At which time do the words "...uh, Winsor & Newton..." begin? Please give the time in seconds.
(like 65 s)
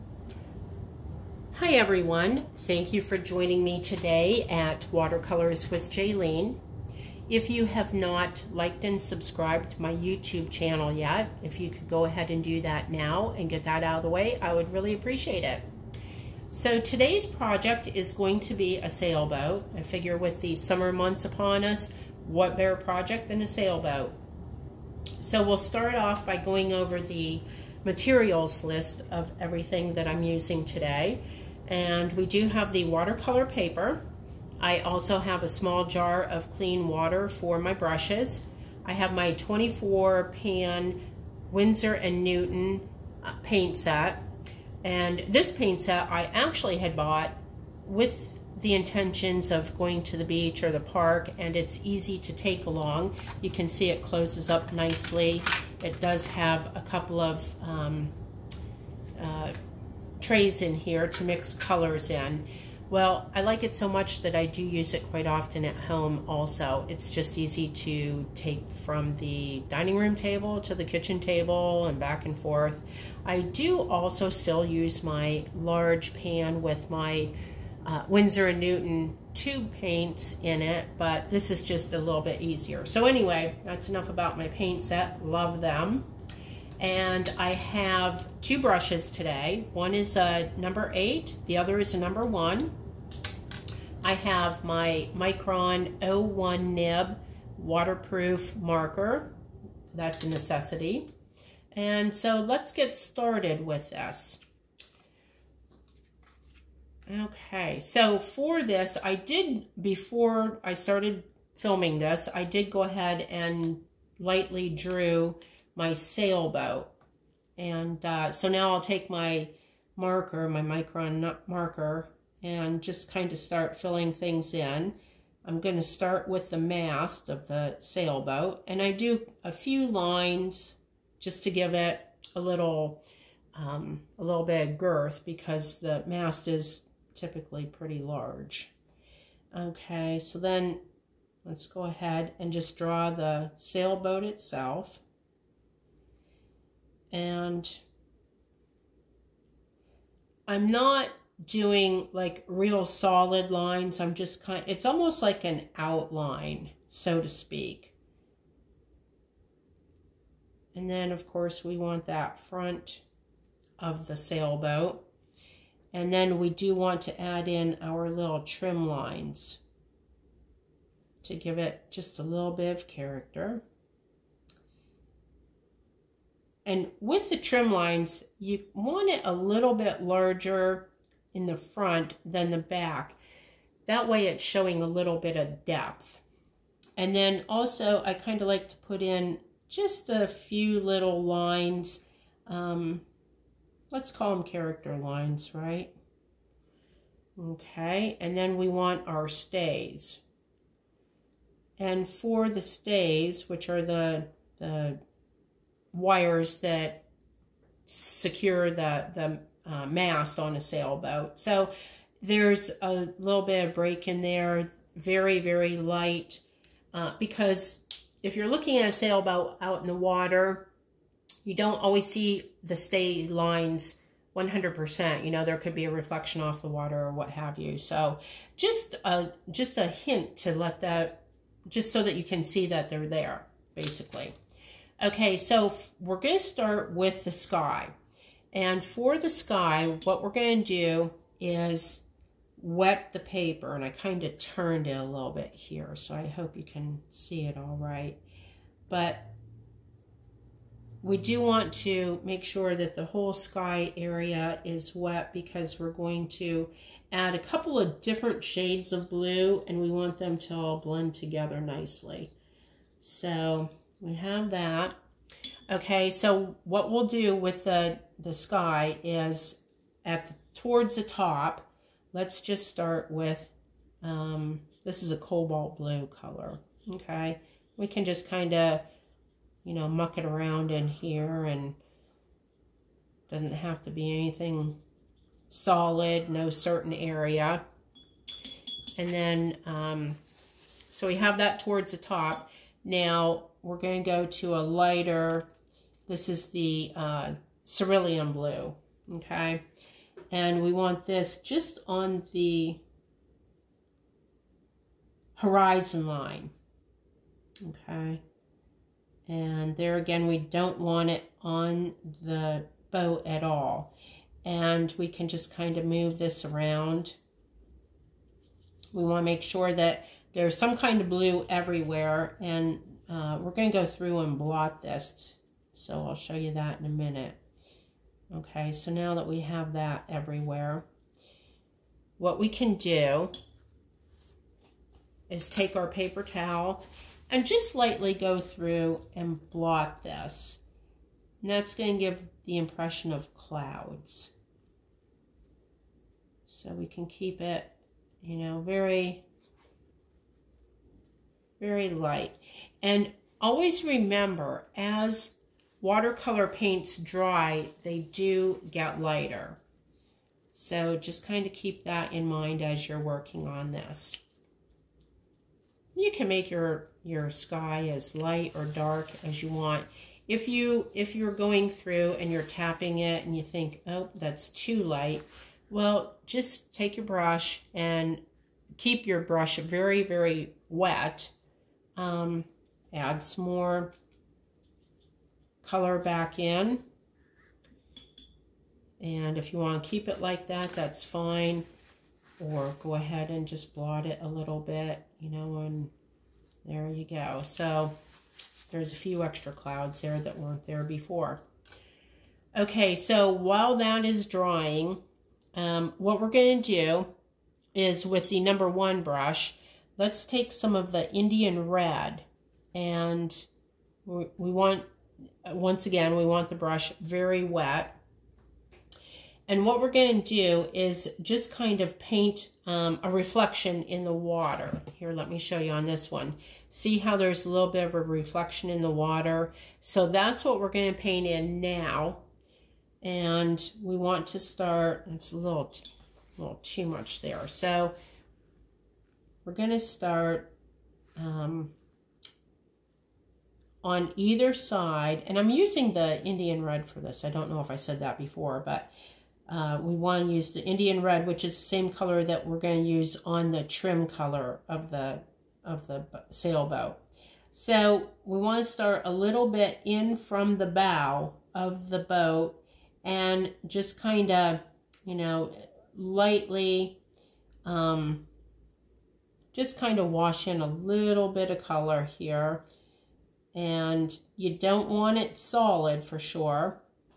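77 s.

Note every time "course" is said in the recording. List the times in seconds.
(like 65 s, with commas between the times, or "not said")
161 s.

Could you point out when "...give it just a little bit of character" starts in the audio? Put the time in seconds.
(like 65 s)
171 s.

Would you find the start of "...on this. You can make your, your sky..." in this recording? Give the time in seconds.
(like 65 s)
363 s.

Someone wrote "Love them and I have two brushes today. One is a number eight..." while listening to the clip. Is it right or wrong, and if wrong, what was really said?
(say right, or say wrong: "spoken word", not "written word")
right.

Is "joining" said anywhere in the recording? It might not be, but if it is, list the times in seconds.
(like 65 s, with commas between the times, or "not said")
3 s.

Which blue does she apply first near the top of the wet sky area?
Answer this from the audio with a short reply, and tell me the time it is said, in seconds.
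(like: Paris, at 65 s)
cobalt blue, at 275 s.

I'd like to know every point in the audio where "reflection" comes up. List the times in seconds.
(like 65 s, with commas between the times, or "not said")
225 s, 423 s, 427 s.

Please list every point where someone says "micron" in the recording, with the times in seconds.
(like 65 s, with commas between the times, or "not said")
95 s, 120 s.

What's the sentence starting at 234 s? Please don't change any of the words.
Okay, so we're going to start with the sky.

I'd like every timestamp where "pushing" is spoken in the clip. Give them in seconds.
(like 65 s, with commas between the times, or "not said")
not said.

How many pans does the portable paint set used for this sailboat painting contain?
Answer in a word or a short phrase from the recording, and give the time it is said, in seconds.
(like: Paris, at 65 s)
24, at 39 s.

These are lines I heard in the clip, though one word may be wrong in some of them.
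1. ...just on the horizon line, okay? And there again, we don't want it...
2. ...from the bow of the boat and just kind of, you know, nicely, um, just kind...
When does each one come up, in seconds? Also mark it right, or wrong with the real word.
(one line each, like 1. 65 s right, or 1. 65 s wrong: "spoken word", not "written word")
1. 301 s right
2. 460 s wrong: "lightly", not "nicely".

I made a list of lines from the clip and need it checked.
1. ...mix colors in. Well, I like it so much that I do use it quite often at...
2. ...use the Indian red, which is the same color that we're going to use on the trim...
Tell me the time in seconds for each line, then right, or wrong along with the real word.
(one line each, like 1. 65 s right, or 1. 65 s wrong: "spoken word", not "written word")
1. 61 s right
2. 450 s right.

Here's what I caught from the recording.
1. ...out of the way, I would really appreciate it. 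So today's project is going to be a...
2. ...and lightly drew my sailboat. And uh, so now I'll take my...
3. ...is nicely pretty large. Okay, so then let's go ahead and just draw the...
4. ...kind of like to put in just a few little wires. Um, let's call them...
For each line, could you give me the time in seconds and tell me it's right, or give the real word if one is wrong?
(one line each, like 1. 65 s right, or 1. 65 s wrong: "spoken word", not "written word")
1. 13 s right
2. 113 s right
3. 136 s wrong: "typically", not "nicely"
4. 188 s wrong: "lines", not "wires".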